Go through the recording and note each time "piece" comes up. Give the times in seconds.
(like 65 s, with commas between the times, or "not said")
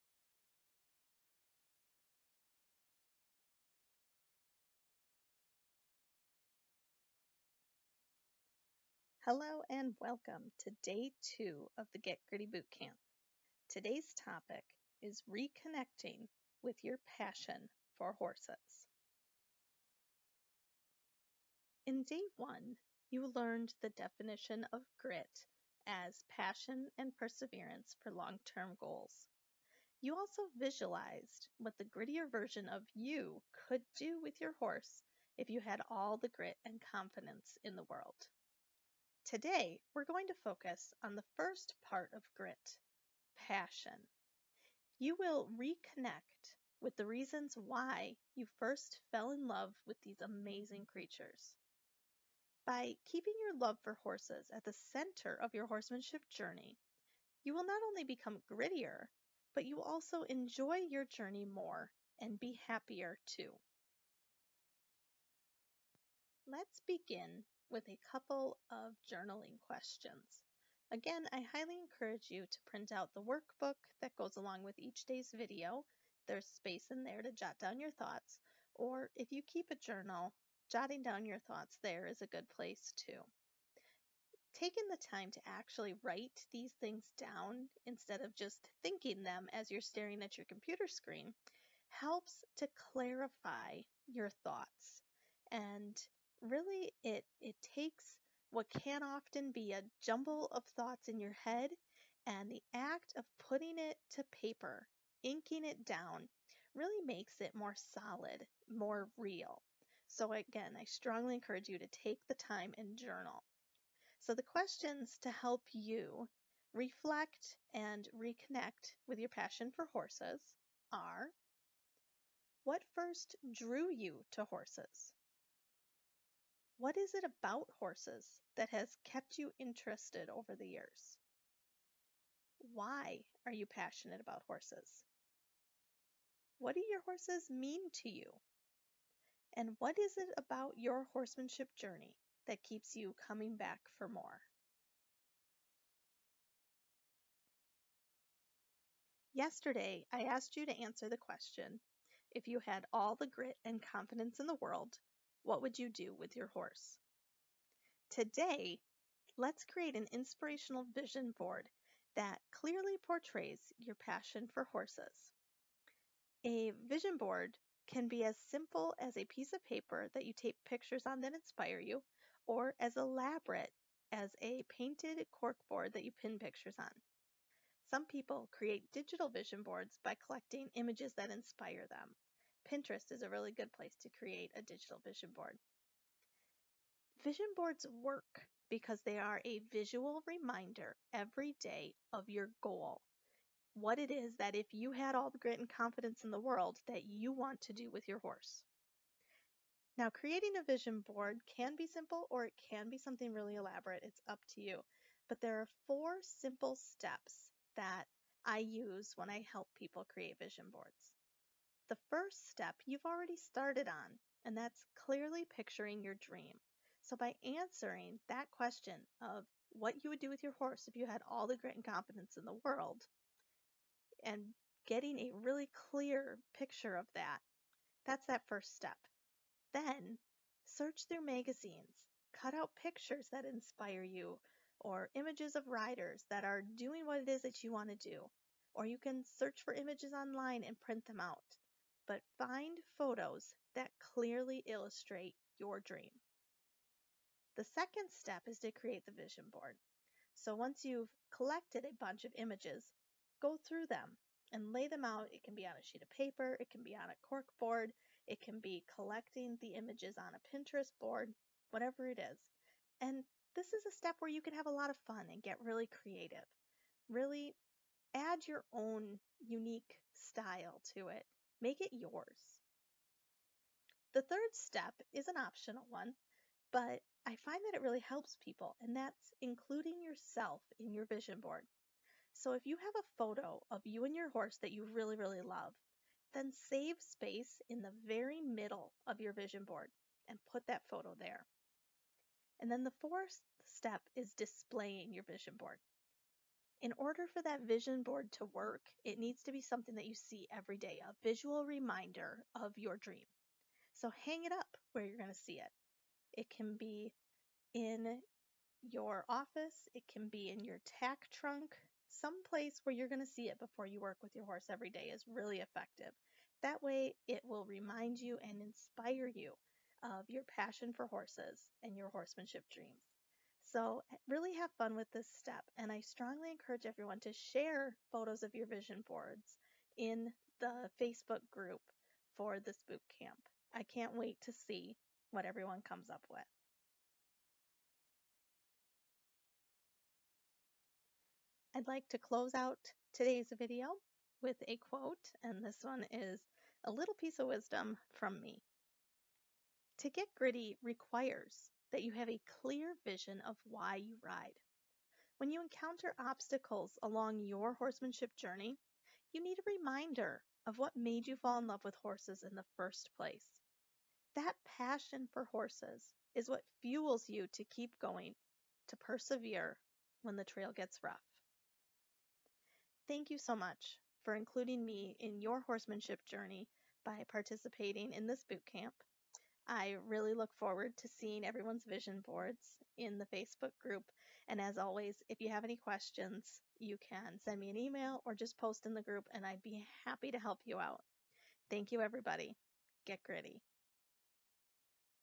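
169 s, 347 s.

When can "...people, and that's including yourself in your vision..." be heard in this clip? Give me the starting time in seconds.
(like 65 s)
278 s.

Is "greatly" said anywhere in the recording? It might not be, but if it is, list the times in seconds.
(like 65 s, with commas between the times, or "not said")
not said.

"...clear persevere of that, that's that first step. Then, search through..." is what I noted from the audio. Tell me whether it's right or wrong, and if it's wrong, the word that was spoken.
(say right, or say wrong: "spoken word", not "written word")
wrong: "picture", not "persevere".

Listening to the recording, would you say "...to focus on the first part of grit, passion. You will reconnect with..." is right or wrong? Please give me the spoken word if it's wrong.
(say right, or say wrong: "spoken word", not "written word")
right.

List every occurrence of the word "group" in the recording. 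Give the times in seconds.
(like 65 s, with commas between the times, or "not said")
331 s, 383 s, 389 s.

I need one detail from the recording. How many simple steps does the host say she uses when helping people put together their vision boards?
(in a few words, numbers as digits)
4.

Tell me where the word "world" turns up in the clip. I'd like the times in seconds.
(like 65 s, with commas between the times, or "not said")
37 s, 154 s, 196 s, 222 s.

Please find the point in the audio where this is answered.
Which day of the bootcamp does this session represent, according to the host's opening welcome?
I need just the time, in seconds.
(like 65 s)
10 s.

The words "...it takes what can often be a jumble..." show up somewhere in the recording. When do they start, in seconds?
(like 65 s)
97 s.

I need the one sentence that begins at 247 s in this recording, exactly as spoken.
The second step is to create the vision board.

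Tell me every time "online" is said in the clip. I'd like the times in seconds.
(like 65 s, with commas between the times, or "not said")
240 s.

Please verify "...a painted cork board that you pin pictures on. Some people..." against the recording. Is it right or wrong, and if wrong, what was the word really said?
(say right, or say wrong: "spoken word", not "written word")
right.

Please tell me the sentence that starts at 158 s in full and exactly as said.
Today, let's create an inspirational vision board that clearly portrays your passion for horses.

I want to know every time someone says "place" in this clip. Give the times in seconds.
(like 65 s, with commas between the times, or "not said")
82 s, 183 s, 312 s, 363 s.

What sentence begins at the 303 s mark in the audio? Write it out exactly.
So hang it up where you're going to see it.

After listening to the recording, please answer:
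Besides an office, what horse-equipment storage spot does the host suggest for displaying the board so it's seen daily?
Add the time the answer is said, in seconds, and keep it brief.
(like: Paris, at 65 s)
Tack trunk, at 310 s.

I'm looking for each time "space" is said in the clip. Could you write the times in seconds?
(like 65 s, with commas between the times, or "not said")
76 s, 286 s.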